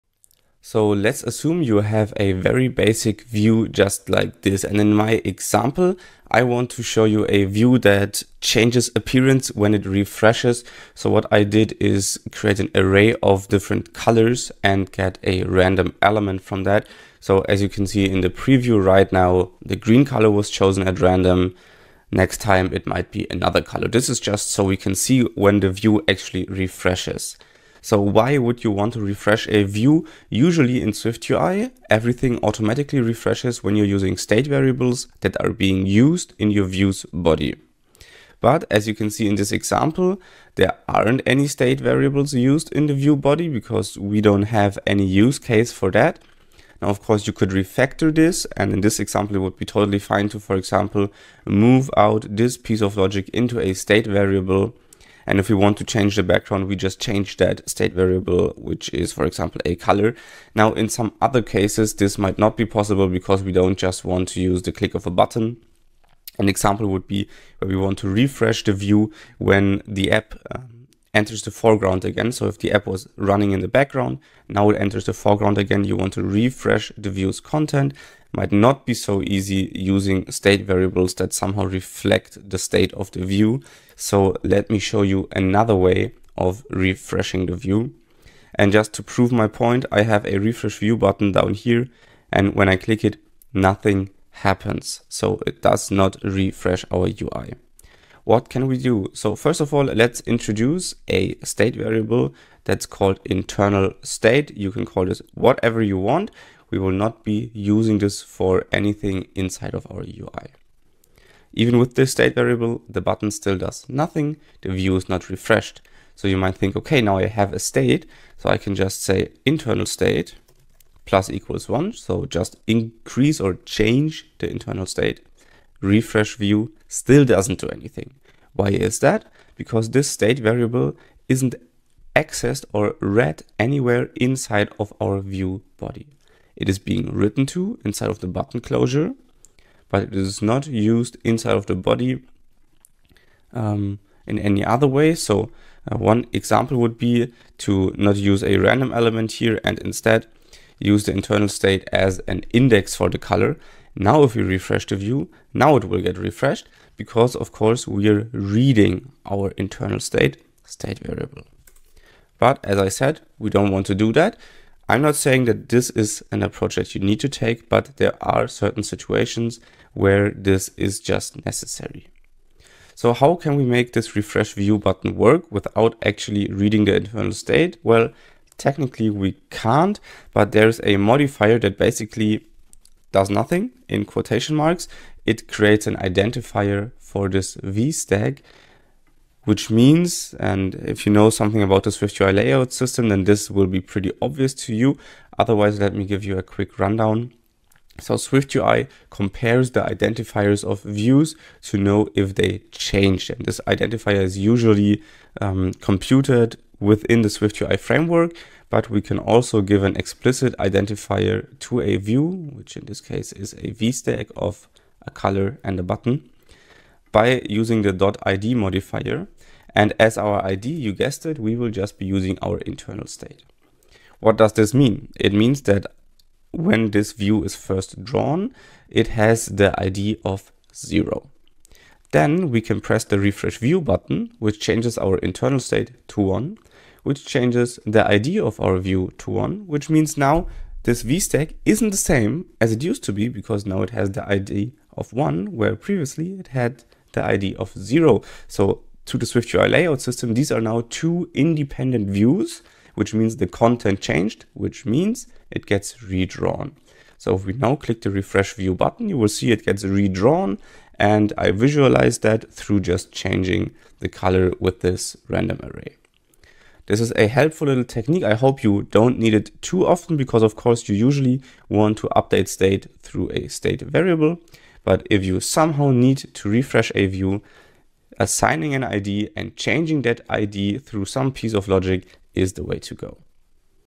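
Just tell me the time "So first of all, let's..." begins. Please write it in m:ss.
1:39.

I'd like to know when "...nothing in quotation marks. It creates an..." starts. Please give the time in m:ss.
3:03.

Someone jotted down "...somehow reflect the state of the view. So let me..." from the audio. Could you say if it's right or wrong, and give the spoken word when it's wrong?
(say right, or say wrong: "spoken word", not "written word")
right.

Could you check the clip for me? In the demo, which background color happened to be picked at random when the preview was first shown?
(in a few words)
green.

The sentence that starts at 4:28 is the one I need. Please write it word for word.
I hope you don't need it too often because of course you usually want to update state through a state variable.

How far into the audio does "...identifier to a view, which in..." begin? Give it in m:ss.
3:30.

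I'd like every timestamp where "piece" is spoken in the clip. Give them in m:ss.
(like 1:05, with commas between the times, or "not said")
0:52, 4:41.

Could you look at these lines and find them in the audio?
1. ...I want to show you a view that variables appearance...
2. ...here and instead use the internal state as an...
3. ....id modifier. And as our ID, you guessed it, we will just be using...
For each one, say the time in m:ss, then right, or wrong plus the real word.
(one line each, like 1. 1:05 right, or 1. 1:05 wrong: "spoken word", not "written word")
1. 0:06 wrong: "changes", not "variables"
2. 2:29 right
3. 3:38 right.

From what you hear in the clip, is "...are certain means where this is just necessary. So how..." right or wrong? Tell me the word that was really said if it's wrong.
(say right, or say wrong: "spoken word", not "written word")
wrong: "situations", not "means".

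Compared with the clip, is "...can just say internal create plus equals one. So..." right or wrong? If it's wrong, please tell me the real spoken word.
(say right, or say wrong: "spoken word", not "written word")
wrong: "state", not "create".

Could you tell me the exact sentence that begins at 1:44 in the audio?
You can call this whatever you want, we will not be using this for anything inside of our UI.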